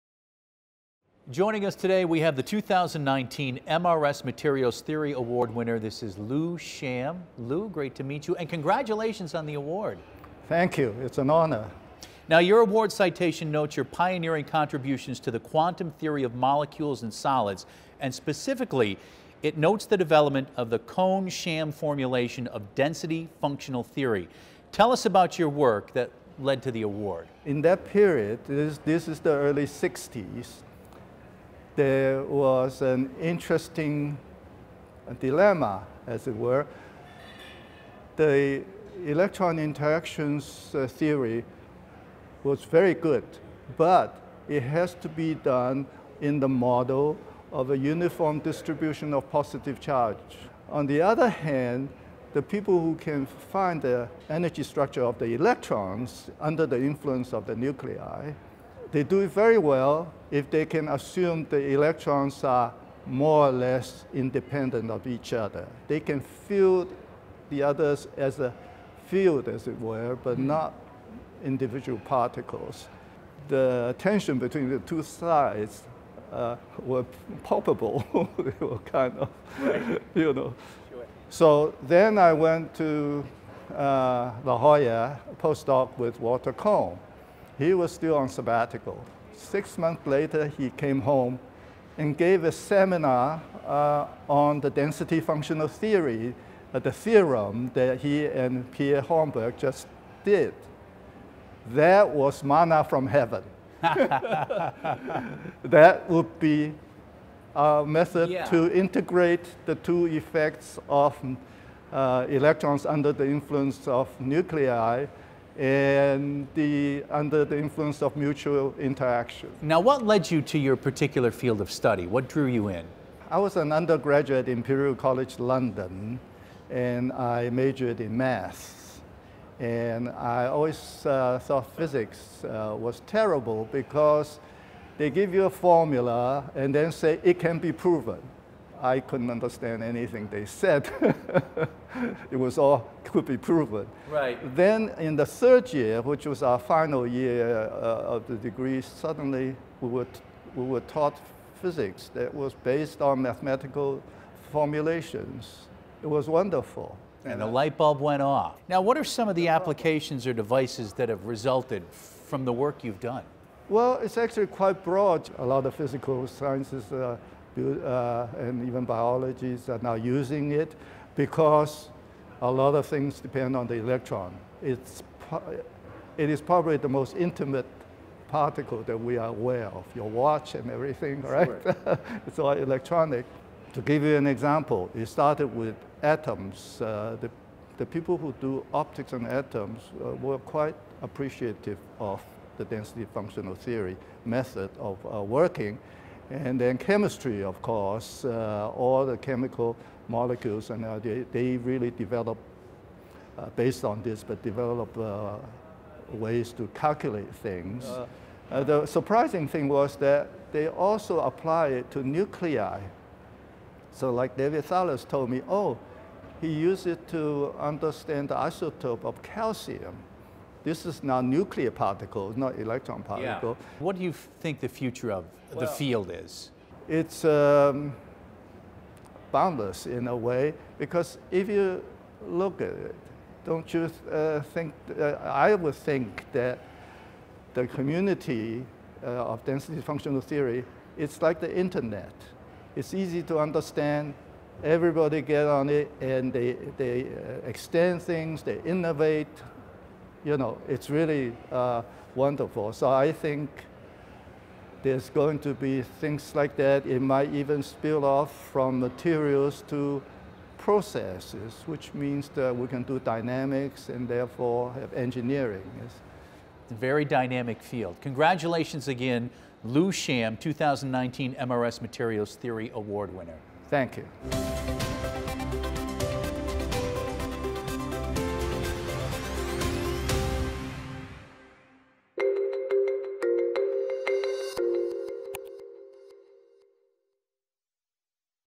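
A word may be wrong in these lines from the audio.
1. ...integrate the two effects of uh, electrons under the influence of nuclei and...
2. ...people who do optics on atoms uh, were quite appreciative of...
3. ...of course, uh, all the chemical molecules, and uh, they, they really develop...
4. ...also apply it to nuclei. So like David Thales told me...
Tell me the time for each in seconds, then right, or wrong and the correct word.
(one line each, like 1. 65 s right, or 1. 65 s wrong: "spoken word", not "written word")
1. 108 s right
2. 187 s right
3. 197 s right
4. 210 s right.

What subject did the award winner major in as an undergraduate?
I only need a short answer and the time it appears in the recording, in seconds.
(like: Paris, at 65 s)
maths, at 128 s.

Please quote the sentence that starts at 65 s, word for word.
They can field the others as a field, as it were, but hmm.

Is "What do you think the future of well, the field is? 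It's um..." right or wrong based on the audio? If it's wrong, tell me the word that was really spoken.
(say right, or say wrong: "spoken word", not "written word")
right.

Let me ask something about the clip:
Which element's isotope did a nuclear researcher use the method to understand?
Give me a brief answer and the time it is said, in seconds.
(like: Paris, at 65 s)
calcium, at 219 s.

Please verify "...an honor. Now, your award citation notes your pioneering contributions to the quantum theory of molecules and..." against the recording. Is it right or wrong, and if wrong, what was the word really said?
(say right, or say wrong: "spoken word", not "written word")
right.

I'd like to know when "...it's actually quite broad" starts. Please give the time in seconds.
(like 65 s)
164 s.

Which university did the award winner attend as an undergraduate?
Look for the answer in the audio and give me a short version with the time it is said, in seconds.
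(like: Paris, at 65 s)
Imperial College London, at 124 s.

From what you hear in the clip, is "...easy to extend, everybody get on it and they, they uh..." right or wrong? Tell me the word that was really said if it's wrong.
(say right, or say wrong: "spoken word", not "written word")
wrong: "understand", not "extend".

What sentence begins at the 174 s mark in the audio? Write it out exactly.
It's, it is probably the most intimate particle that we are aware of, your watch and everything, right?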